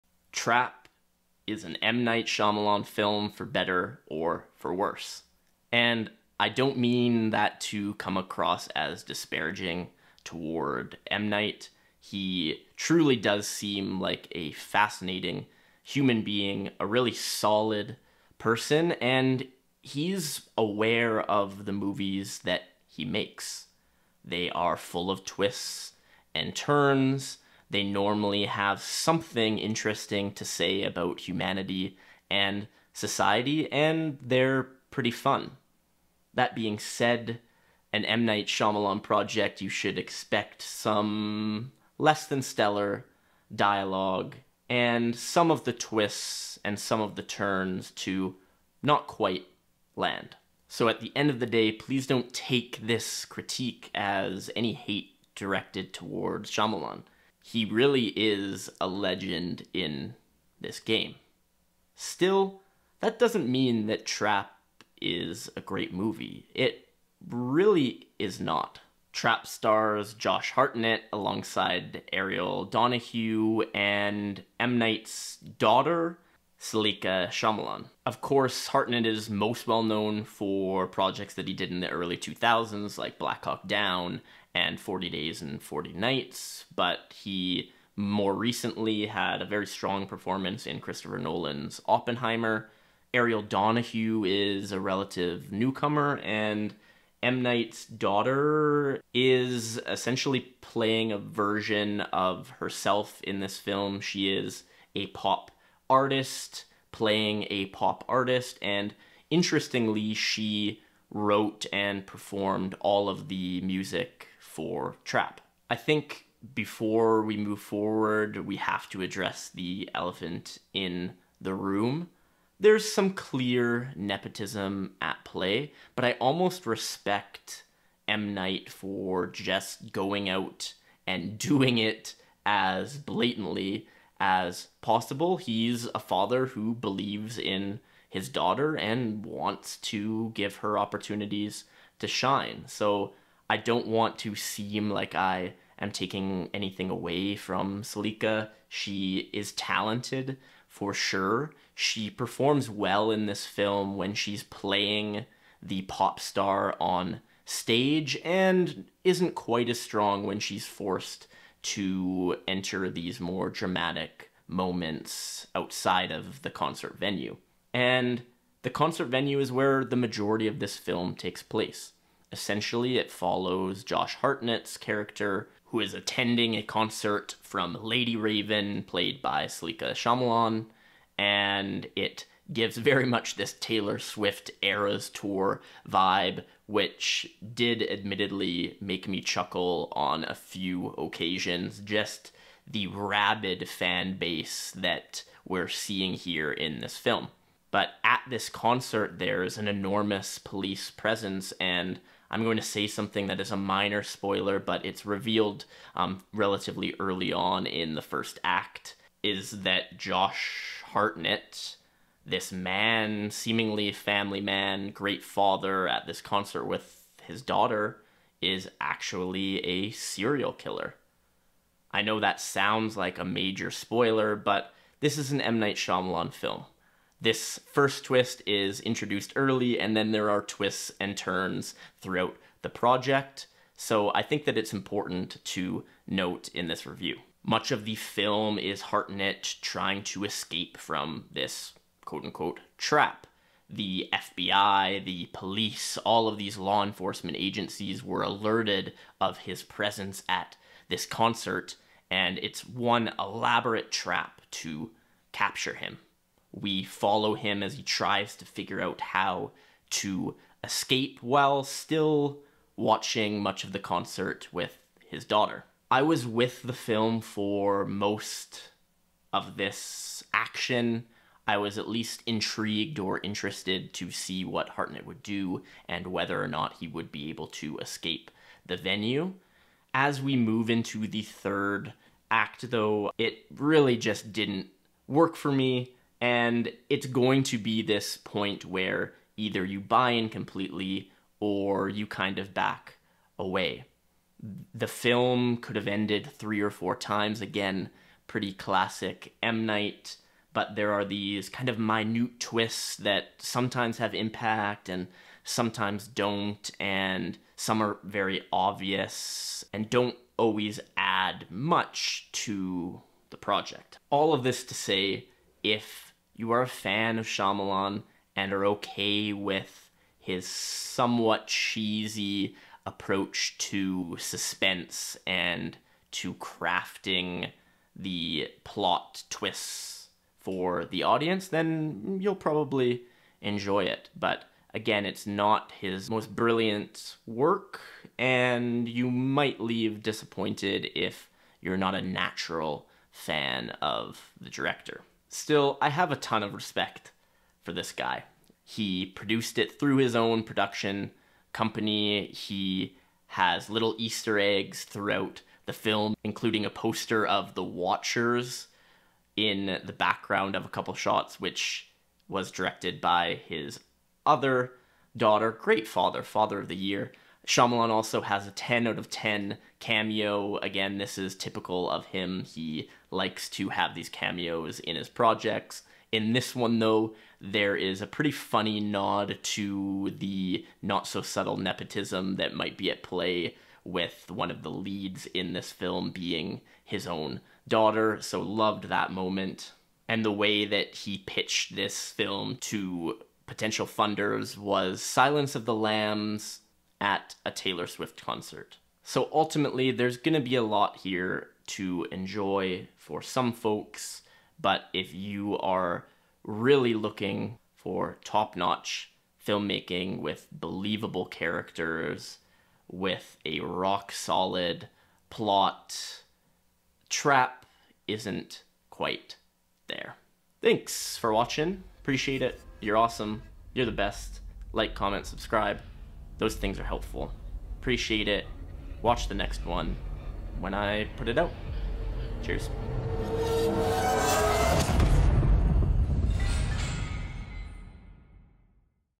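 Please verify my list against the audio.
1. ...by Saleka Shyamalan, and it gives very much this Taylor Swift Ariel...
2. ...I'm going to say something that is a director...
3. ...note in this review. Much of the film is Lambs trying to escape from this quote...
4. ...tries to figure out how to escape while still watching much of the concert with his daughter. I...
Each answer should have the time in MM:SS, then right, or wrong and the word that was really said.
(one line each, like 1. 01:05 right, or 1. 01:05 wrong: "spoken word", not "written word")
1. 02:59 wrong: "Eras", not "Ariel"
2. 03:22 wrong: "minor", not "director"
3. 03:56 wrong: "Hartnett", not "Lambs"
4. 04:17 right.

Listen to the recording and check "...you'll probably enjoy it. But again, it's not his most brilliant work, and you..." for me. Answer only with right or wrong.
right.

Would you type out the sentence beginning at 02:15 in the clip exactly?
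He's a father who believes in his daughter and wants to give her opportunities to shine.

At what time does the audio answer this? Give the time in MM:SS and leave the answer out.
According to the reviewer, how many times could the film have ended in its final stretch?
04:56.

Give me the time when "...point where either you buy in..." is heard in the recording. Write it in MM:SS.
04:48.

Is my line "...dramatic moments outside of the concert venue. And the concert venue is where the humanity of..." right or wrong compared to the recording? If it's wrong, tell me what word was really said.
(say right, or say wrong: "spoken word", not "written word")
wrong: "majority", not "humanity".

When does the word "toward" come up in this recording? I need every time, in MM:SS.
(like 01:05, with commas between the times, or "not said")
00:10, 00:55.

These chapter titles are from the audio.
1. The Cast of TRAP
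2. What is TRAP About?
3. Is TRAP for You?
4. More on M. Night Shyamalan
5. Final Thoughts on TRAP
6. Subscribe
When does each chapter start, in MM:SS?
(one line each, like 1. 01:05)
1. 01:08
2. 02:47
3. 05:13
4. 05:44
5. 06:38
6. 07:00.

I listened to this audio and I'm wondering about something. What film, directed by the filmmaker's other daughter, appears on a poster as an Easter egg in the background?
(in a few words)
The Watchers.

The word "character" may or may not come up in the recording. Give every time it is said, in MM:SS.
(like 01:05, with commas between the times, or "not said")
02:54, 06:51.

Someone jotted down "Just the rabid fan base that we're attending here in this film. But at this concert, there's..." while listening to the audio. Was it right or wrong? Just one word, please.
wrong.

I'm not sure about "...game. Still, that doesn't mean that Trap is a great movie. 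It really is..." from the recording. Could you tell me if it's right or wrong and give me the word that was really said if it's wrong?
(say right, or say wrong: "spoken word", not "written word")
right.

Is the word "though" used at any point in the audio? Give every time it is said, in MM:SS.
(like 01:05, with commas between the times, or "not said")
04:42, 06:16.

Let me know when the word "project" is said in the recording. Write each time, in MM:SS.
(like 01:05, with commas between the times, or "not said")
00:39, 01:20, 03:52, 05:13, 06:15.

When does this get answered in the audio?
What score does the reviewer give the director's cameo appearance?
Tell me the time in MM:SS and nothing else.
06:08.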